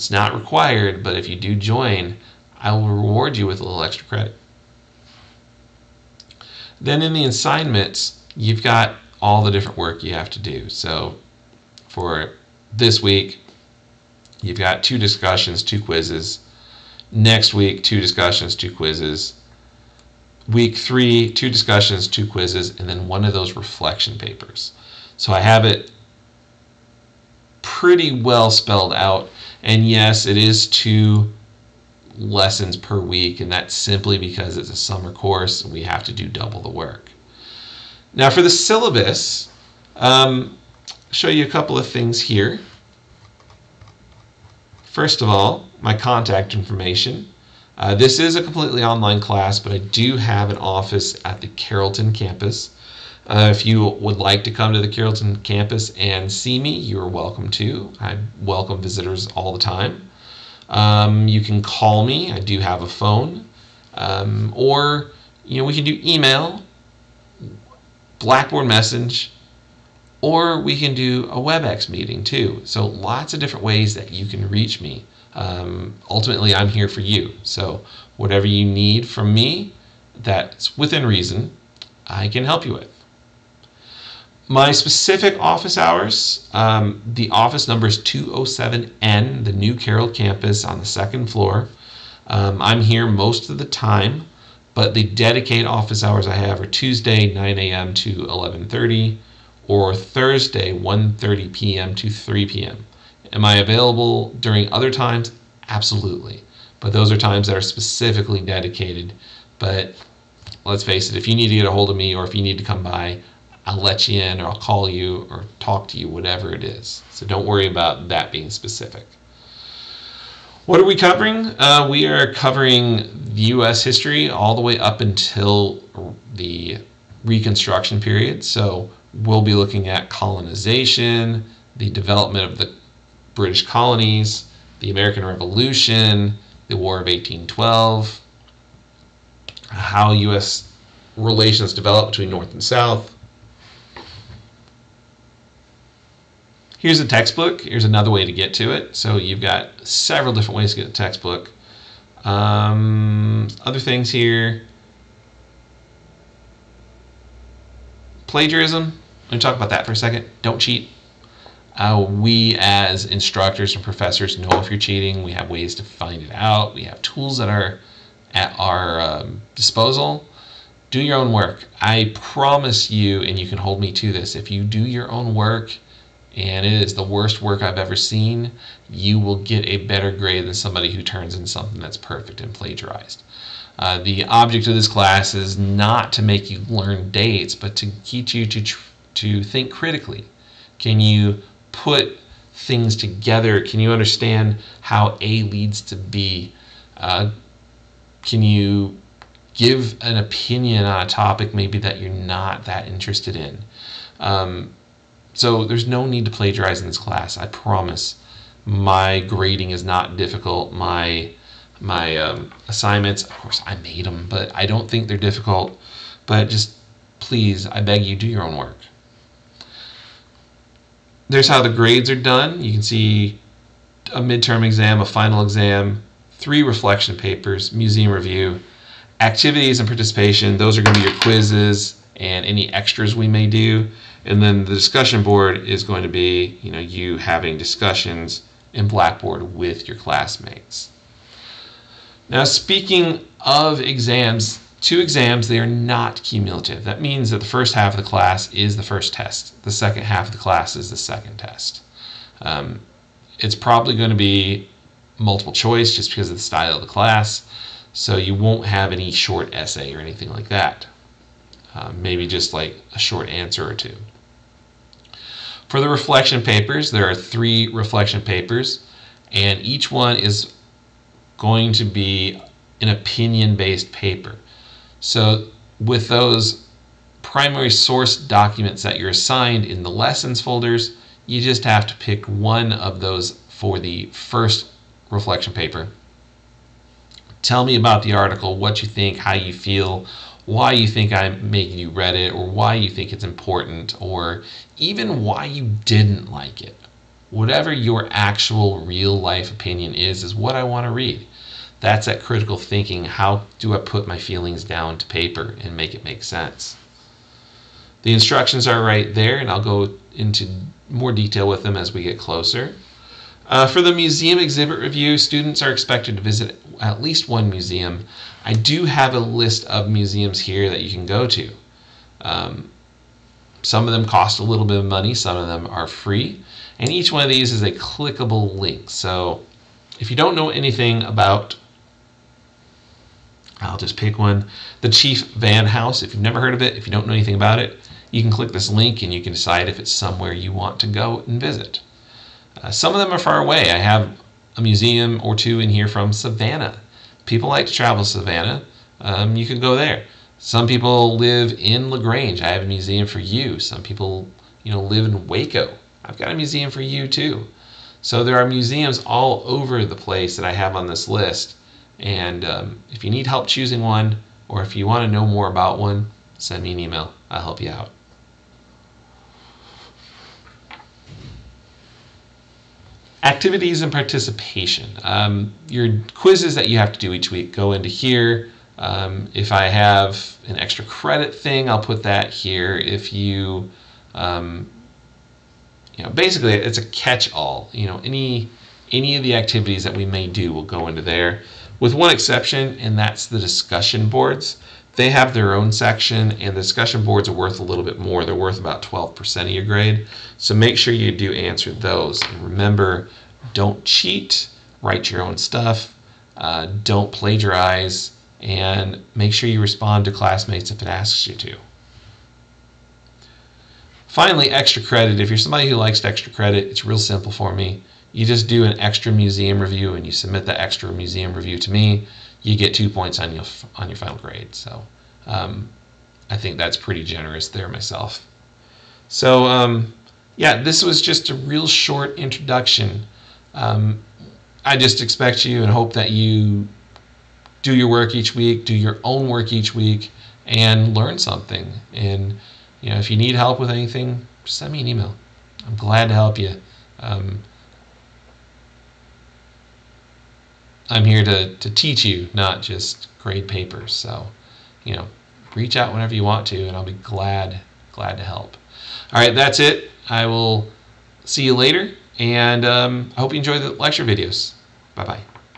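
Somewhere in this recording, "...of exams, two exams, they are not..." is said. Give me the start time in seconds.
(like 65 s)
243 s.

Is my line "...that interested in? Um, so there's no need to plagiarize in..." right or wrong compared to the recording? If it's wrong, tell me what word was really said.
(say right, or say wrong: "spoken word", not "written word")
right.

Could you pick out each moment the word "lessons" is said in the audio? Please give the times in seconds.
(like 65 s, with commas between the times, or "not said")
32 s, 279 s.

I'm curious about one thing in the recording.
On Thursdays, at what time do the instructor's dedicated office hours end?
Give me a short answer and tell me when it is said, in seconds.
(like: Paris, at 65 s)
3 p.m., at 102 s.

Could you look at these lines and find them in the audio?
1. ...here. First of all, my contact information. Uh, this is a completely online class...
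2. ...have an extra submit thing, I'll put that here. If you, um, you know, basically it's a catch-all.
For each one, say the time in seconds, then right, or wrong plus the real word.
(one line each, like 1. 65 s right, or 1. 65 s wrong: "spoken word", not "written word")
1. 42 s right
2. 379 s wrong: "credit", not "submit".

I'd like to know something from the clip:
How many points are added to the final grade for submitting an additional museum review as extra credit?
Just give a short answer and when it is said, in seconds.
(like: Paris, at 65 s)
2, at 422 s.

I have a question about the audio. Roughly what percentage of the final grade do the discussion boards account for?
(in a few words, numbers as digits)
12%.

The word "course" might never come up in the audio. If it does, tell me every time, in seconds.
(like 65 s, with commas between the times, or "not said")
35 s, 213 s.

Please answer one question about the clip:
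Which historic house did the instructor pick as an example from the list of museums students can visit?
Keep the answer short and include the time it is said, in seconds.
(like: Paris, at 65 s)
Chief Vann House, at 334 s.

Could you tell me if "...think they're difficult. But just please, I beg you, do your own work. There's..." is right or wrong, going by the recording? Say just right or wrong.
right.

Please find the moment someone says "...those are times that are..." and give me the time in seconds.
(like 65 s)
106 s.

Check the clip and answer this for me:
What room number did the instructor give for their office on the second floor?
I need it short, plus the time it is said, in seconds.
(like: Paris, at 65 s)
207N, at 87 s.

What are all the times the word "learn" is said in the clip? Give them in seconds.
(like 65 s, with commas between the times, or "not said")
186 s, 440 s.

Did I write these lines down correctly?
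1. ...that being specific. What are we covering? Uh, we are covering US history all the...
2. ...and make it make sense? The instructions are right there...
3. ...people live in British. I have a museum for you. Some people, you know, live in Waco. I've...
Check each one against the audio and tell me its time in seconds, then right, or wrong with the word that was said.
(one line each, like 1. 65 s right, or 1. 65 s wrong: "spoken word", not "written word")
1. 118 s right
2. 305 s right
3. 350 s wrong: "LaGrange", not "British".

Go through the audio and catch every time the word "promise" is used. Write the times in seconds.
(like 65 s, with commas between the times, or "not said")
172 s, 207 s.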